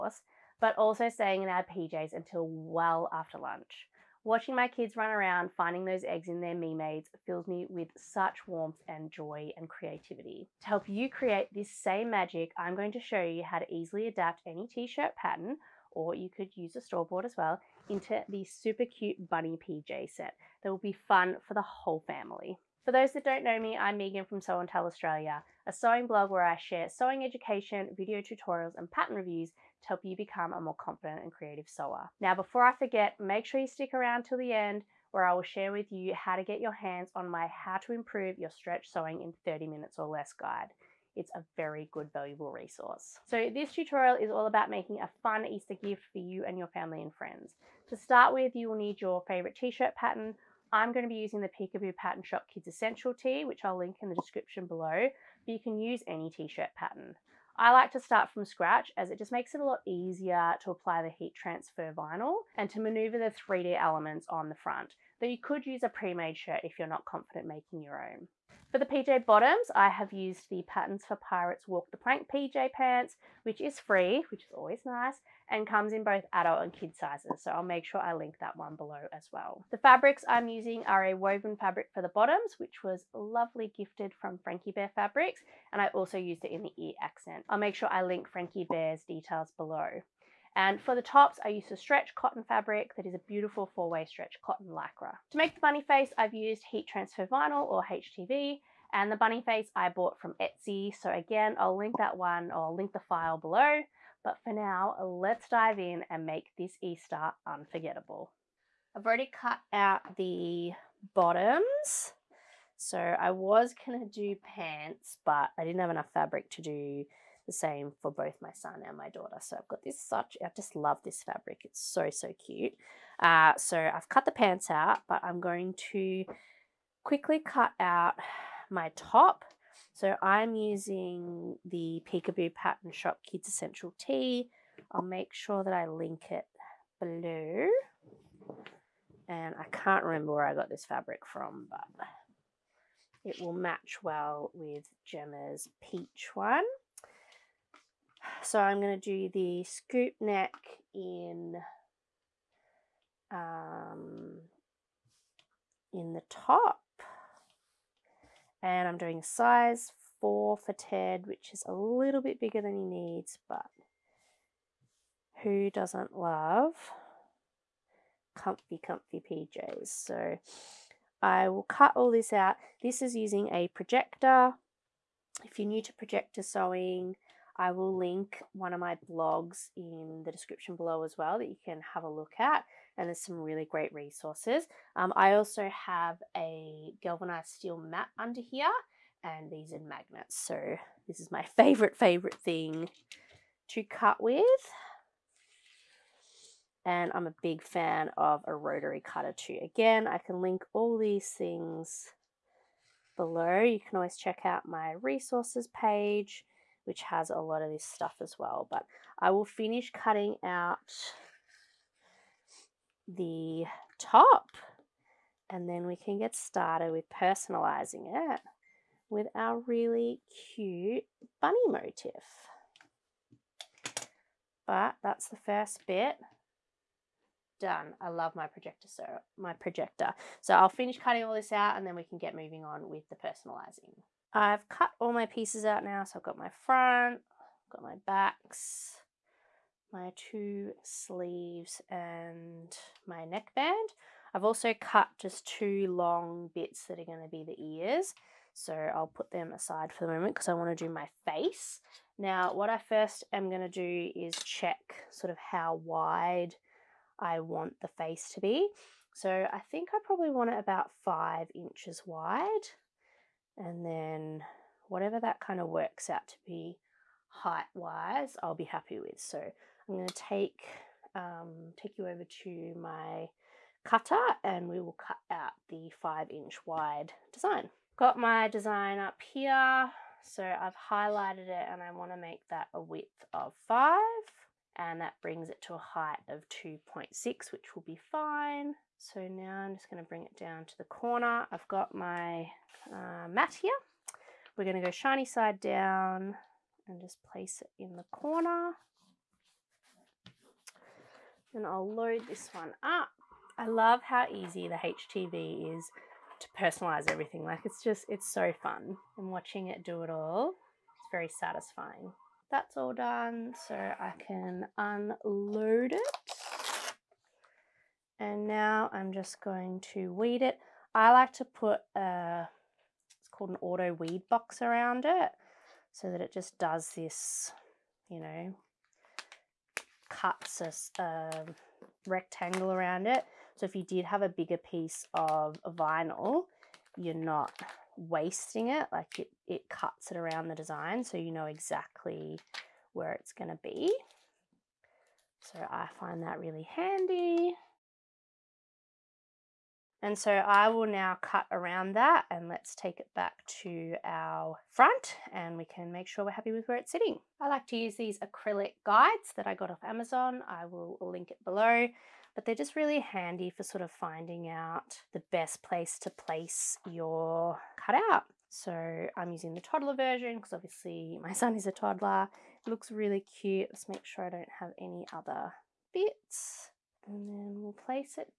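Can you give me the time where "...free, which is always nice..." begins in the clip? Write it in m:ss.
1:13.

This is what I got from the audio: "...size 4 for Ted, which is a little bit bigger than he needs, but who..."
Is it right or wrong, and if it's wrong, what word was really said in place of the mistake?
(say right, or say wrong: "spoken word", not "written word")
right.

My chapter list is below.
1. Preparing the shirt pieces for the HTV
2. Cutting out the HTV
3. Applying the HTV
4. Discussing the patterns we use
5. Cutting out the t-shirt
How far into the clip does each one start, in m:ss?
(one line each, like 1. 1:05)
1. 3:55
2. 4:37
3. 5:55
4. 0:50
5. 1:47.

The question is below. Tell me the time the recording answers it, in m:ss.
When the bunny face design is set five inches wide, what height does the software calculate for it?
4:46.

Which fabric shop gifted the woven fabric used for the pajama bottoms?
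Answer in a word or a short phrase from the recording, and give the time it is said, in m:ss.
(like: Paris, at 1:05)
Frankie Bear Fabrics, at 1:24.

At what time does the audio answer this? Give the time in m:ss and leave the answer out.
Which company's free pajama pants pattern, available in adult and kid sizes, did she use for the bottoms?
1:10.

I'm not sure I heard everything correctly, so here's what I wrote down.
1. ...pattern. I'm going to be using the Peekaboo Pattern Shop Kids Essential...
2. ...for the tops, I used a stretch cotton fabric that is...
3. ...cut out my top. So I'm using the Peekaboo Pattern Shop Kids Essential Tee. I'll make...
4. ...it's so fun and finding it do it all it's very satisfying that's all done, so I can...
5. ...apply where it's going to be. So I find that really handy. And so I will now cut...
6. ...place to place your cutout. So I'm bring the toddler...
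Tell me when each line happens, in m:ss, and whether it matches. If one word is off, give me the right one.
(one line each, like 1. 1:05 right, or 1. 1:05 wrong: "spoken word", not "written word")
1. 0:49 right
2. 1:30 right
3. 2:07 right
4. 5:08 wrong: "watching", not "finding"
5. 5:41 wrong: "exactly", not "apply"
6. 6:05 wrong: "using", not "bring".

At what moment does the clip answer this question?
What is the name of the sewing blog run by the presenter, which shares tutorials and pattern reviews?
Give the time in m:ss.
0:24.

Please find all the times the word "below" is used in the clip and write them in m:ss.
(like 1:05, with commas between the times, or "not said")
0:54, 1:18, 1:29, 1:43, 2:17, 3:00, 3:23, 6:01.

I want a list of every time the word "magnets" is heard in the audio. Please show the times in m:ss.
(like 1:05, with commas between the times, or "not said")
3:09.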